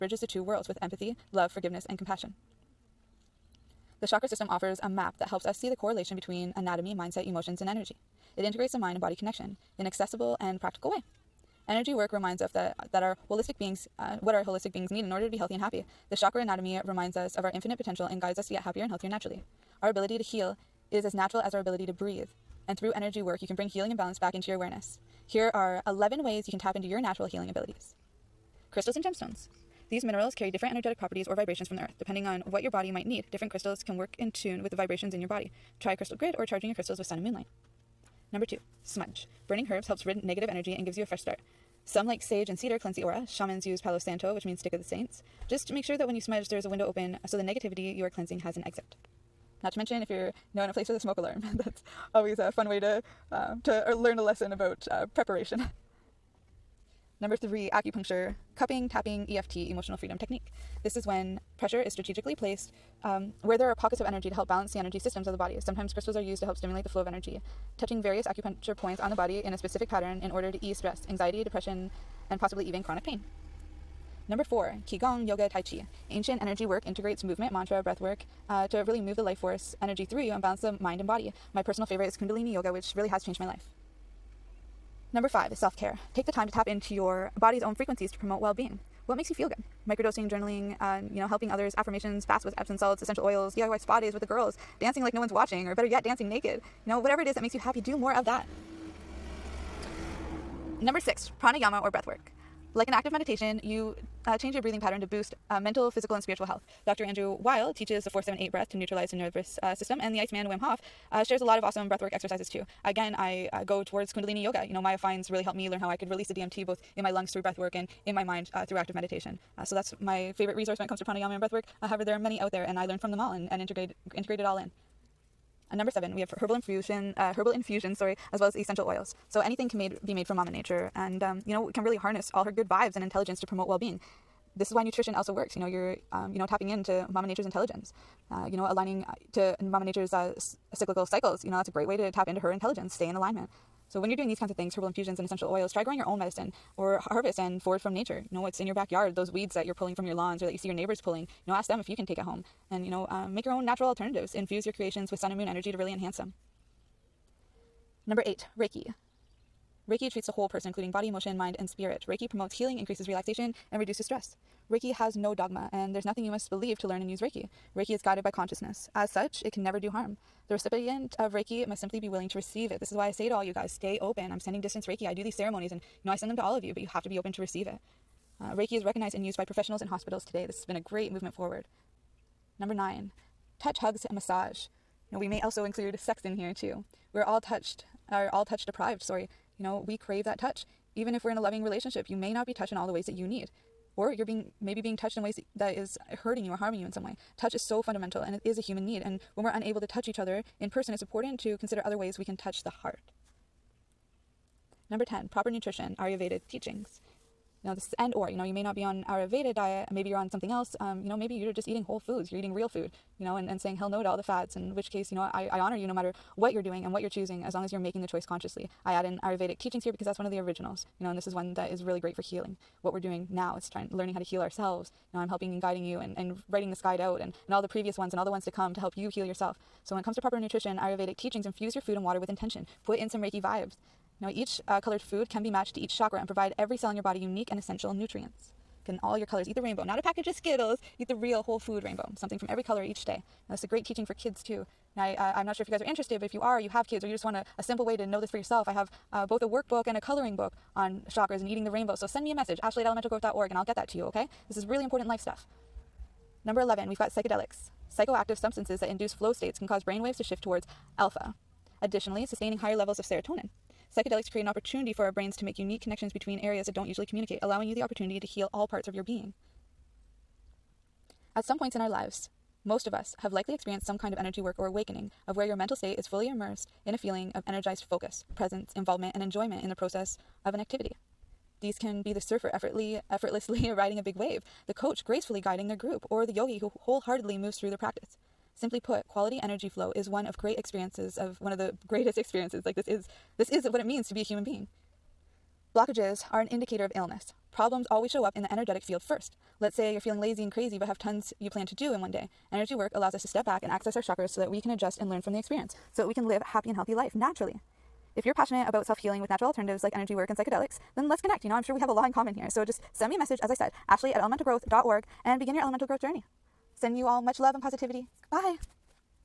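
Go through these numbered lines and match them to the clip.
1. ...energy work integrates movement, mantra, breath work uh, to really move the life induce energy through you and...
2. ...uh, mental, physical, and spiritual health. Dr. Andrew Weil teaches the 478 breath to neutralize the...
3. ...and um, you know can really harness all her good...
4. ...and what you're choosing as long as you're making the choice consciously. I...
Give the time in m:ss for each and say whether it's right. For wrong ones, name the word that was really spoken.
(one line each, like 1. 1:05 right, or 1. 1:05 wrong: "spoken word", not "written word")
1. 1:16 wrong: "force", not "induce"
2. 1:45 right
3. 2:10 right
4. 3:36 right.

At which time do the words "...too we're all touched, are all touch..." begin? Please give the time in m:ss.
3:06.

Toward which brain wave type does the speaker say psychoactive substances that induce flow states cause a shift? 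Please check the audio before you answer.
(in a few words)
Alpha.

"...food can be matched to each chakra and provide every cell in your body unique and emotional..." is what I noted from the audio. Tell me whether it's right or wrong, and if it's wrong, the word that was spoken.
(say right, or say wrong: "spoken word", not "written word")
wrong: "essential", not "emotional".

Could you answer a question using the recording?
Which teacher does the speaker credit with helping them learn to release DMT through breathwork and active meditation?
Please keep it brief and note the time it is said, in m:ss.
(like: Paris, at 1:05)
Maya Fiennes, at 1:54.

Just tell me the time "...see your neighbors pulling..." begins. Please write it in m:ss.
2:30.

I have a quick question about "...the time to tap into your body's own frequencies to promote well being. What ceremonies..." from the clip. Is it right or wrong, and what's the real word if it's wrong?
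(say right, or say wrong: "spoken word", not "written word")
wrong: "makes", not "ceremonies".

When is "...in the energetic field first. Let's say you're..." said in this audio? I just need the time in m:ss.
4:58.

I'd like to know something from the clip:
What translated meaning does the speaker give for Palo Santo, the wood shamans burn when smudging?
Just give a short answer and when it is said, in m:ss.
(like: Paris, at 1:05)
Stick of the saints, at 0:44.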